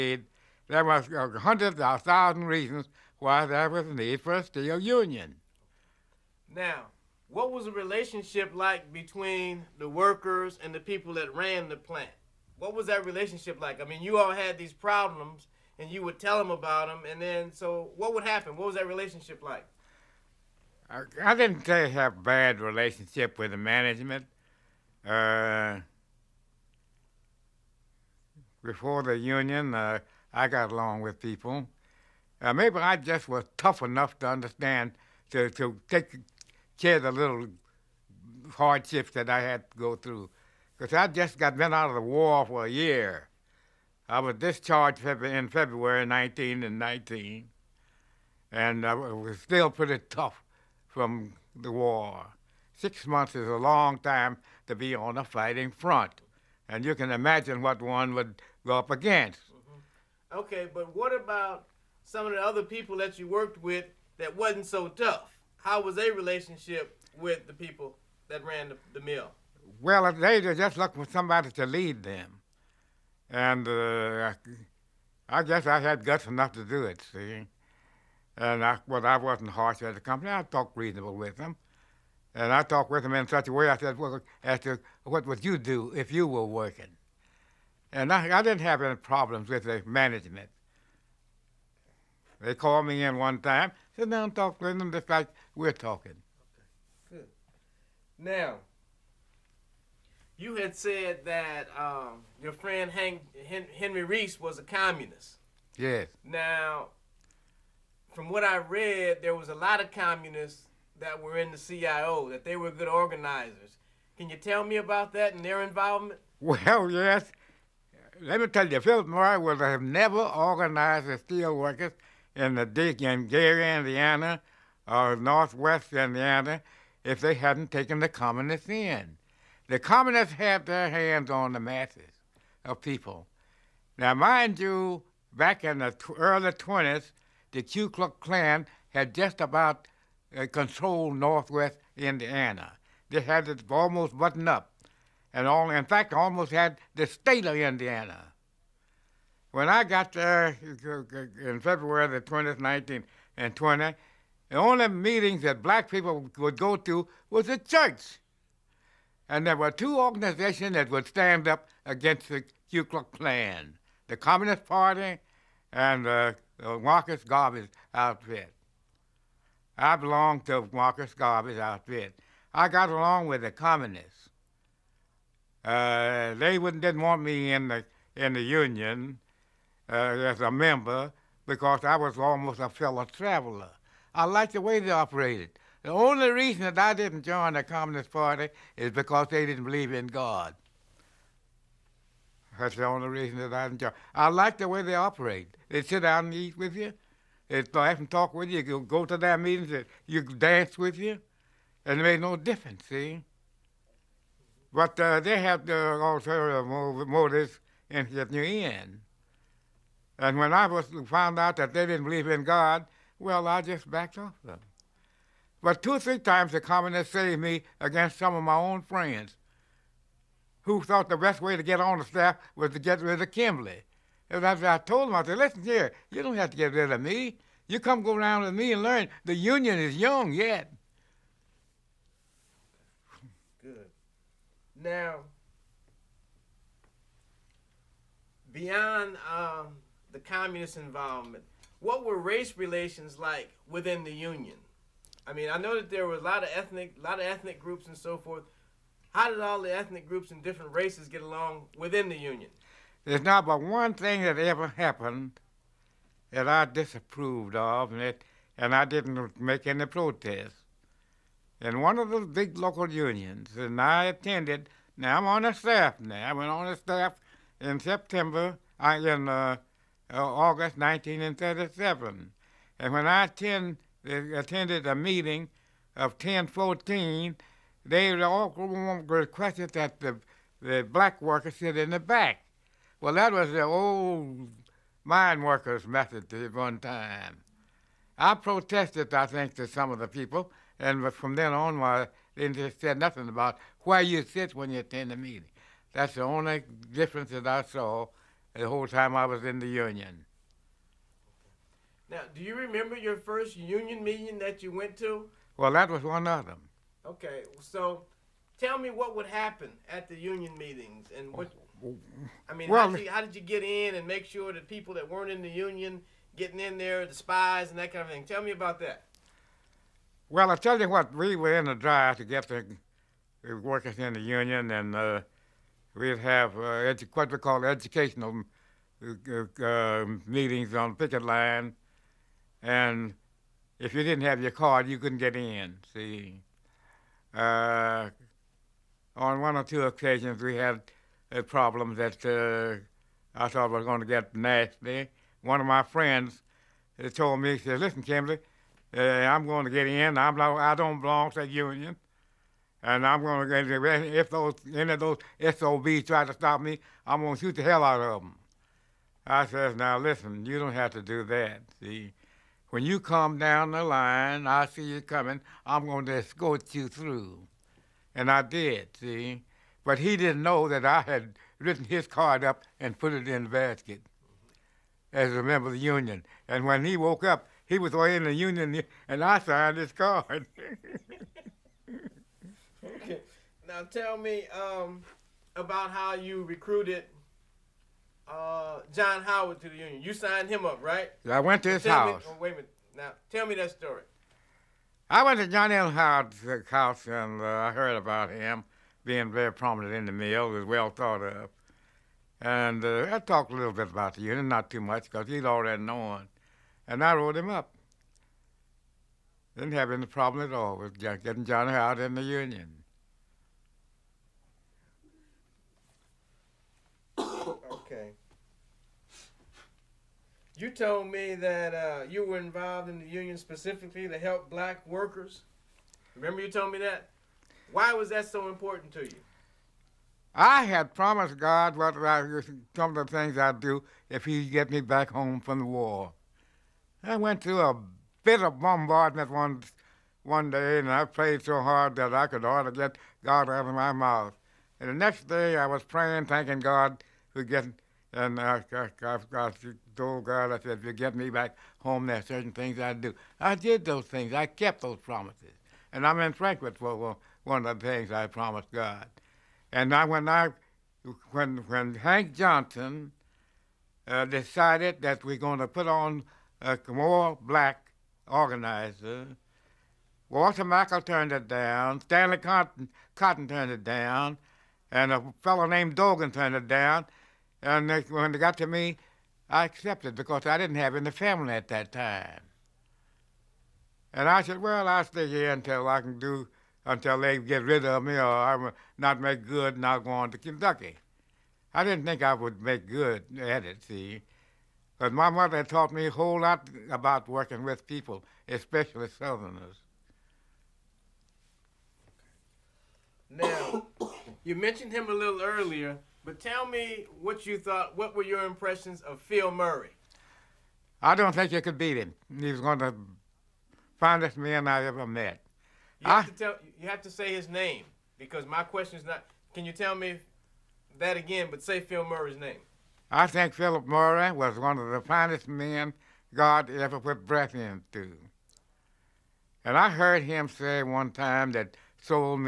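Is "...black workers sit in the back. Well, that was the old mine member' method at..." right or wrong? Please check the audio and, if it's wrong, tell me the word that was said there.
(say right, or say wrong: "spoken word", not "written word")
wrong: "workers", not "member".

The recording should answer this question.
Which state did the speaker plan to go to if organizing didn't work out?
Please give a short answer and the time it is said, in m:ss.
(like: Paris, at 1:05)
Kentucky, at 8:10.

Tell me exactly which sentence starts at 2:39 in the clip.
And there were two organizations that would stand up against the Ku Klux Klan, the Communist Party and the Marcus Garvey's outfit.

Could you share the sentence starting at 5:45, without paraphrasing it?
One of my friends told me, he said, "Listen, Kimbley, I'm going to get in.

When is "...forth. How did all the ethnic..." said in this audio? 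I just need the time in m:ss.
4:08.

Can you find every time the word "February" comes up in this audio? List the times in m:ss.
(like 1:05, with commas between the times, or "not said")
0:45, 2:31.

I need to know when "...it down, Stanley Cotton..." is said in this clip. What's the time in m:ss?
7:51.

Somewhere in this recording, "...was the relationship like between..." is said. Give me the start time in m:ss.
0:07.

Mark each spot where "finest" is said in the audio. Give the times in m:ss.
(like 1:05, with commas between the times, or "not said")
8:33, 8:45.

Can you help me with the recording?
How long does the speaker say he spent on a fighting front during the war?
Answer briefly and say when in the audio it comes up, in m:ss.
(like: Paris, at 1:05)
Six months, at 0:52.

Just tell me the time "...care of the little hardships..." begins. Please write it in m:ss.
0:36.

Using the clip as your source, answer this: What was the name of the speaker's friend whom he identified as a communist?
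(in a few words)
Henry Reese.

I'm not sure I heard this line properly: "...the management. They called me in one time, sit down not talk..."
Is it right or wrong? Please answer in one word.
right.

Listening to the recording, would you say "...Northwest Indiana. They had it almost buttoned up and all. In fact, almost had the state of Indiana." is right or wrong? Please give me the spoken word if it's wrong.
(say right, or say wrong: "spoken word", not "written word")
right.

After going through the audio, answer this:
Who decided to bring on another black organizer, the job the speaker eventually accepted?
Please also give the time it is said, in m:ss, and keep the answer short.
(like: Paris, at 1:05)
Hank Johnson, at 7:41.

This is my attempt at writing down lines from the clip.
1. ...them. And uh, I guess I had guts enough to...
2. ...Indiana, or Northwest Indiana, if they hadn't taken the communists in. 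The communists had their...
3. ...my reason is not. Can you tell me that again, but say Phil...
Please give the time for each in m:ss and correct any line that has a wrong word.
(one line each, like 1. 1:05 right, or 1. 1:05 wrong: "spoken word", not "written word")
1. 1:12 right
2. 2:03 right
3. 8:38 wrong: "question", not "reason".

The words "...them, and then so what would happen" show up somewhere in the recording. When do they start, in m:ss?
0:16.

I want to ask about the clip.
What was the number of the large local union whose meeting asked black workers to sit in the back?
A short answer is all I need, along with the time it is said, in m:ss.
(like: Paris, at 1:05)
1014, at 4:36.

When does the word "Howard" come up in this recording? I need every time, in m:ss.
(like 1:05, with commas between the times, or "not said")
6:29, 6:35, 6:51.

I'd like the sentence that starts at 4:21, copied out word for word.
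In one of the big local unions, and I attended now I'm on the staff.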